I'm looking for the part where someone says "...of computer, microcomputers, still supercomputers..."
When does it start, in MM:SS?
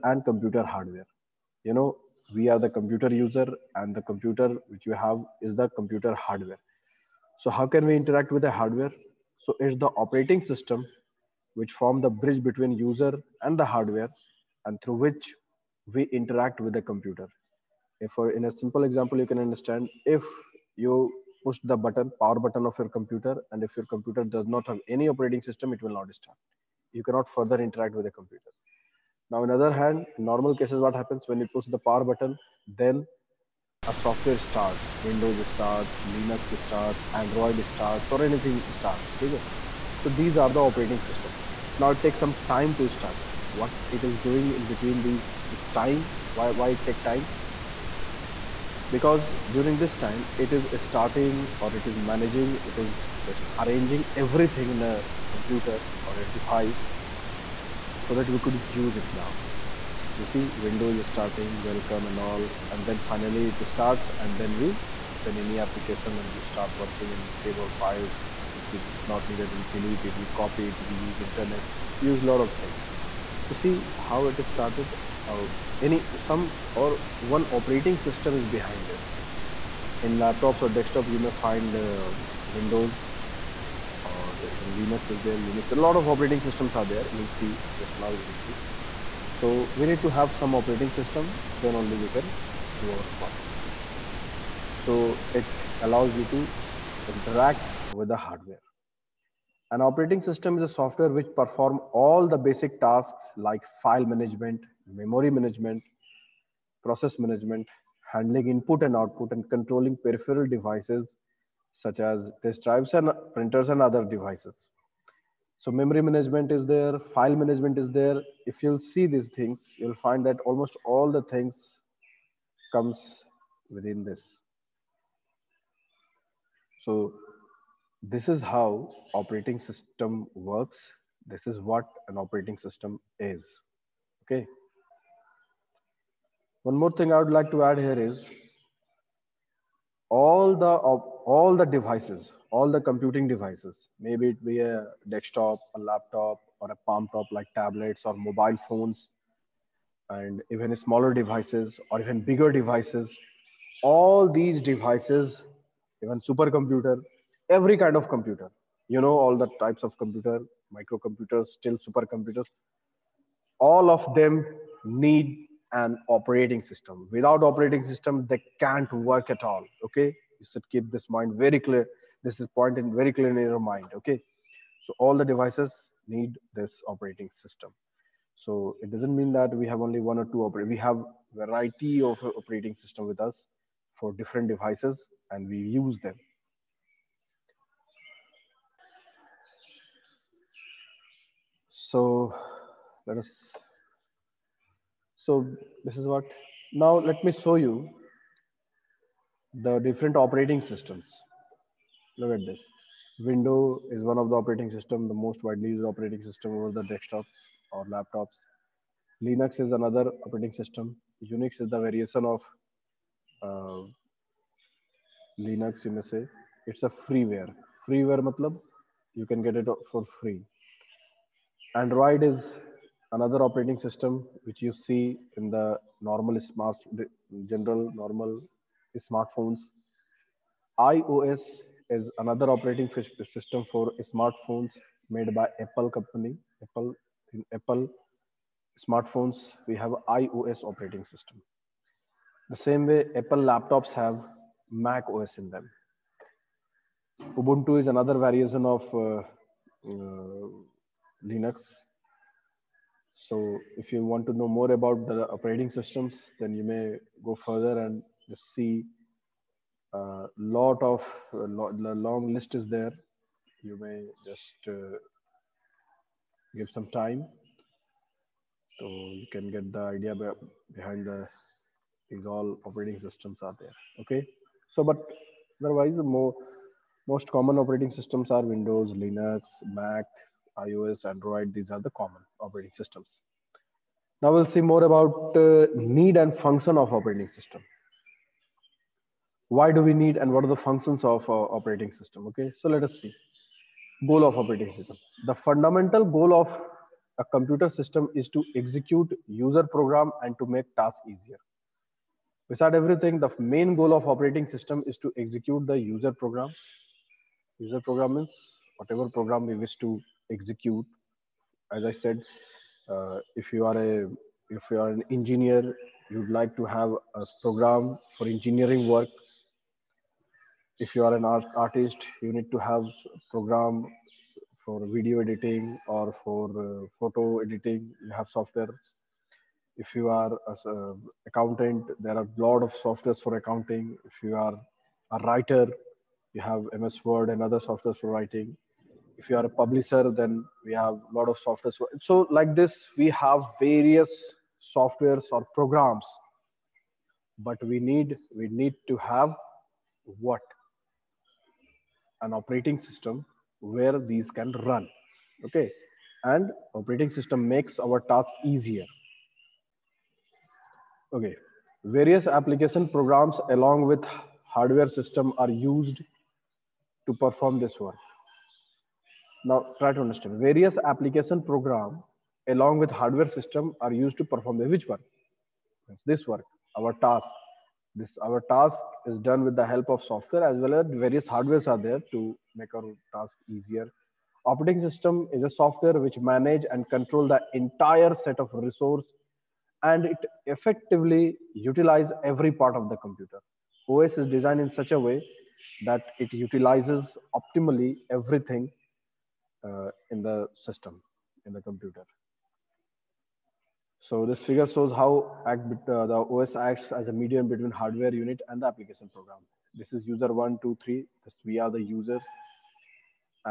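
02:39.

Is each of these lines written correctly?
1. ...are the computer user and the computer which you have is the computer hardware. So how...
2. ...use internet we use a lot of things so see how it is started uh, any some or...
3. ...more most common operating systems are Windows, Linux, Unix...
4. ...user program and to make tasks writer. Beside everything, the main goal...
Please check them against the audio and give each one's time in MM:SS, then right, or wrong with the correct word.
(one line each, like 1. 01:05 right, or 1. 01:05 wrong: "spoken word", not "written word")
1. 00:02 right
2. 01:10 right
3. 04:35 wrong: "Mac", not "Unix"
4. 04:59 wrong: "easier", not "writer".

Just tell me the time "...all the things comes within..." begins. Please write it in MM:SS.
02:00.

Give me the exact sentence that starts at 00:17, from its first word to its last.
If in a simple example, you can understand if you push the button, power button of your computer.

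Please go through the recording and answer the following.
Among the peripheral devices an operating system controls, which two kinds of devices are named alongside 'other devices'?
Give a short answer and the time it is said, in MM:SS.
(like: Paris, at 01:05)
disk drives and printers, at 01:52.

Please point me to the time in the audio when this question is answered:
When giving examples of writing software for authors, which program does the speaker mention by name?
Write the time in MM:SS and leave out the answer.
05:36.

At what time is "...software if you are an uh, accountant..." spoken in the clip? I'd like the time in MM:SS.
05:28.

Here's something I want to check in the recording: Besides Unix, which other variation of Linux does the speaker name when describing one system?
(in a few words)
Ubuntu.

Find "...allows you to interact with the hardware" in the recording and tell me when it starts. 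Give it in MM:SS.
01:35.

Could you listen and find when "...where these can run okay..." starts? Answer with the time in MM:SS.
05:53.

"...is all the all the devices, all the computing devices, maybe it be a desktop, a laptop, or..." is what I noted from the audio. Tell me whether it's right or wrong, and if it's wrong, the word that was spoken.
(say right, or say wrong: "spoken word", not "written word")
right.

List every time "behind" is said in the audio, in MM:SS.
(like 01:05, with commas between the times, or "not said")
01:18, 04:30.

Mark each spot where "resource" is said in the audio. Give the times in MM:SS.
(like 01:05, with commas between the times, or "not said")
06:28.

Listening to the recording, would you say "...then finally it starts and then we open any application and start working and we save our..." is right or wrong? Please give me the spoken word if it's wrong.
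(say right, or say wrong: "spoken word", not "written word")
right.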